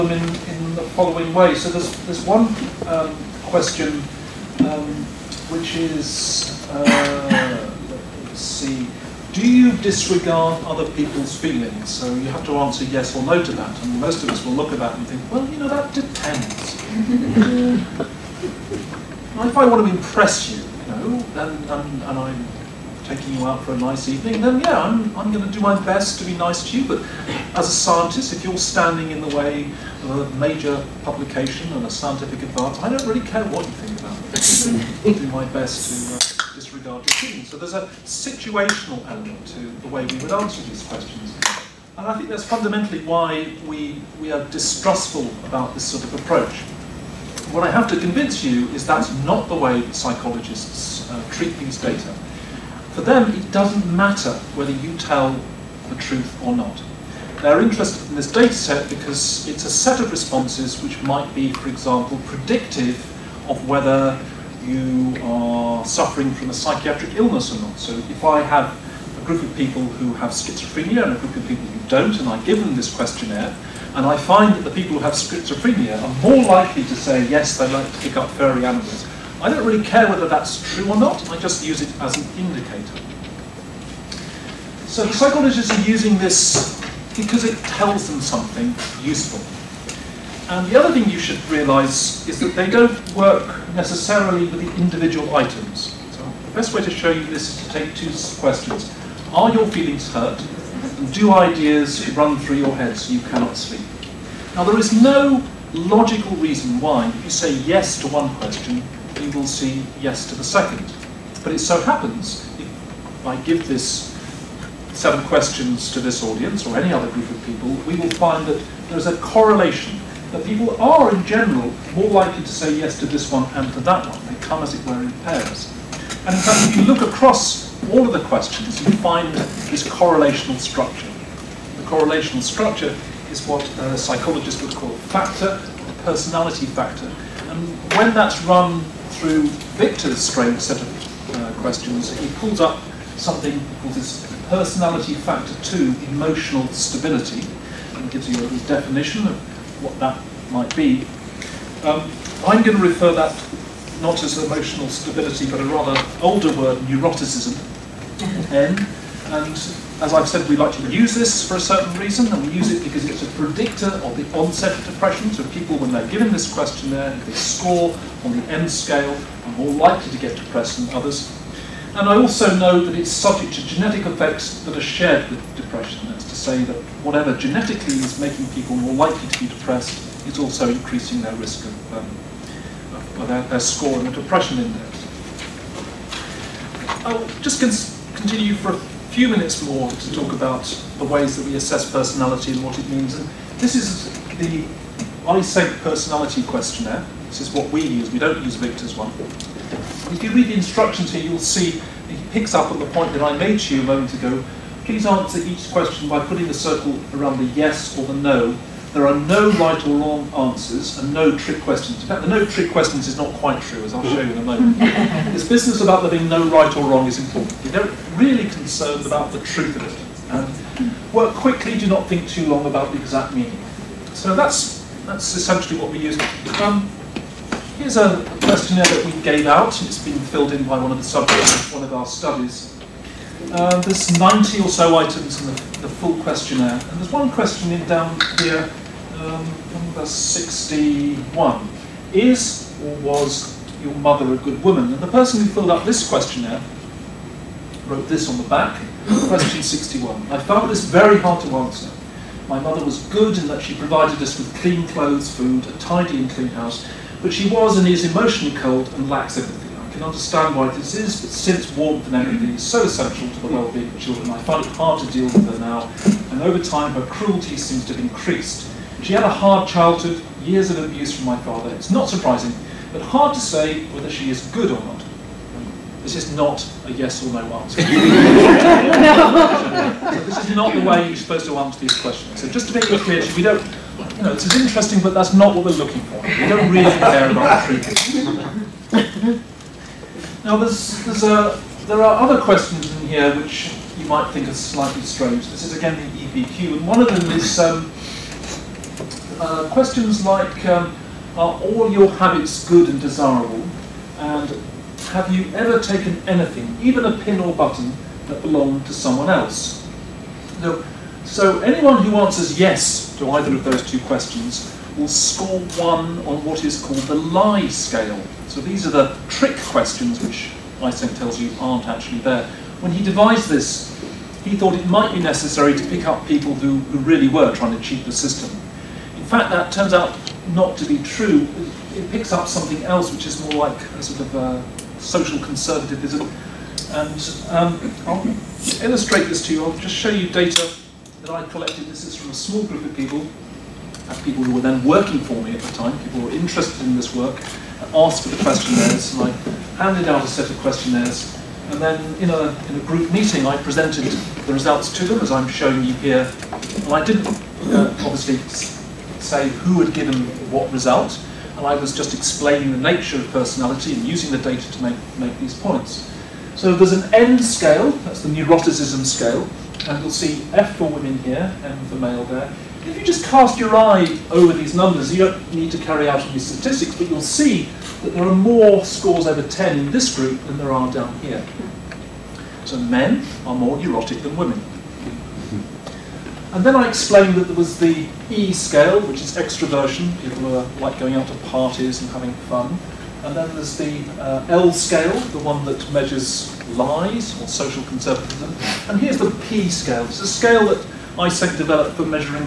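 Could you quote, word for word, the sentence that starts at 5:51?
And then in a, in a group meeting, I presented the results to them, as I'm showing you here.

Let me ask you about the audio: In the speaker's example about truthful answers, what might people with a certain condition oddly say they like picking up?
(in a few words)
furry animals.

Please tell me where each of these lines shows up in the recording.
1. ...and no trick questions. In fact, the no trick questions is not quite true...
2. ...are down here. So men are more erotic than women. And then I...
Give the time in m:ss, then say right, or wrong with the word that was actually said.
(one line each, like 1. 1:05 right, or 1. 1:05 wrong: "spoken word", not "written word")
1. 3:30 right
2. 6:20 right.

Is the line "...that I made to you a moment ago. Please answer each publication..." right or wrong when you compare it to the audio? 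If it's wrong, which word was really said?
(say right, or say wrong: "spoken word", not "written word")
wrong: "question", not "publication".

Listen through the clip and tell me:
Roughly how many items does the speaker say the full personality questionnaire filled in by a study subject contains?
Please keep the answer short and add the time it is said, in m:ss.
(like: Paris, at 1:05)
90, at 3:54.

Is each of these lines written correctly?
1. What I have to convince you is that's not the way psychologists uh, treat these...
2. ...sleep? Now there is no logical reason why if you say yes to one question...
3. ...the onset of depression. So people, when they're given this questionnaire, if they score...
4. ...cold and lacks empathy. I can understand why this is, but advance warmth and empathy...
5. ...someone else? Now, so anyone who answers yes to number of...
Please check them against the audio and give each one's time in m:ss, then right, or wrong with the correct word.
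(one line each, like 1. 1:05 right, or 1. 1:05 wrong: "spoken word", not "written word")
1. 0:47 right
2. 1:43 right
3. 2:44 right
4. 4:18 wrong: "since", not "advance"
5. 5:08 wrong: "either", not "number".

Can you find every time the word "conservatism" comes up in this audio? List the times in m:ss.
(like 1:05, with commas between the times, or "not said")
5:35, 6:37.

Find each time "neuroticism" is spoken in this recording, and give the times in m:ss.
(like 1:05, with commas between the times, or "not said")
2:36, 6:08.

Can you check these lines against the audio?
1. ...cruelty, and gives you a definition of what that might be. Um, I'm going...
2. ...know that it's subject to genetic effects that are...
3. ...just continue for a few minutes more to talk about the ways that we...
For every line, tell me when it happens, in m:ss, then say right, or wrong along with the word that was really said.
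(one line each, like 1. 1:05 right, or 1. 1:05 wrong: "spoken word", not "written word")
1. 2:26 wrong: "stability", not "cruelty"
2. 2:52 right
3. 3:07 right.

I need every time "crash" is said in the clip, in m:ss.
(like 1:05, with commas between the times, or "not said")
not said.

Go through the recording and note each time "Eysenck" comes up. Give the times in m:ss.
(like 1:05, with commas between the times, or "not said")
3:15, 5:20, 6:41.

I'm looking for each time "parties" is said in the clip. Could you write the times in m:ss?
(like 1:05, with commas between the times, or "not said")
6:31.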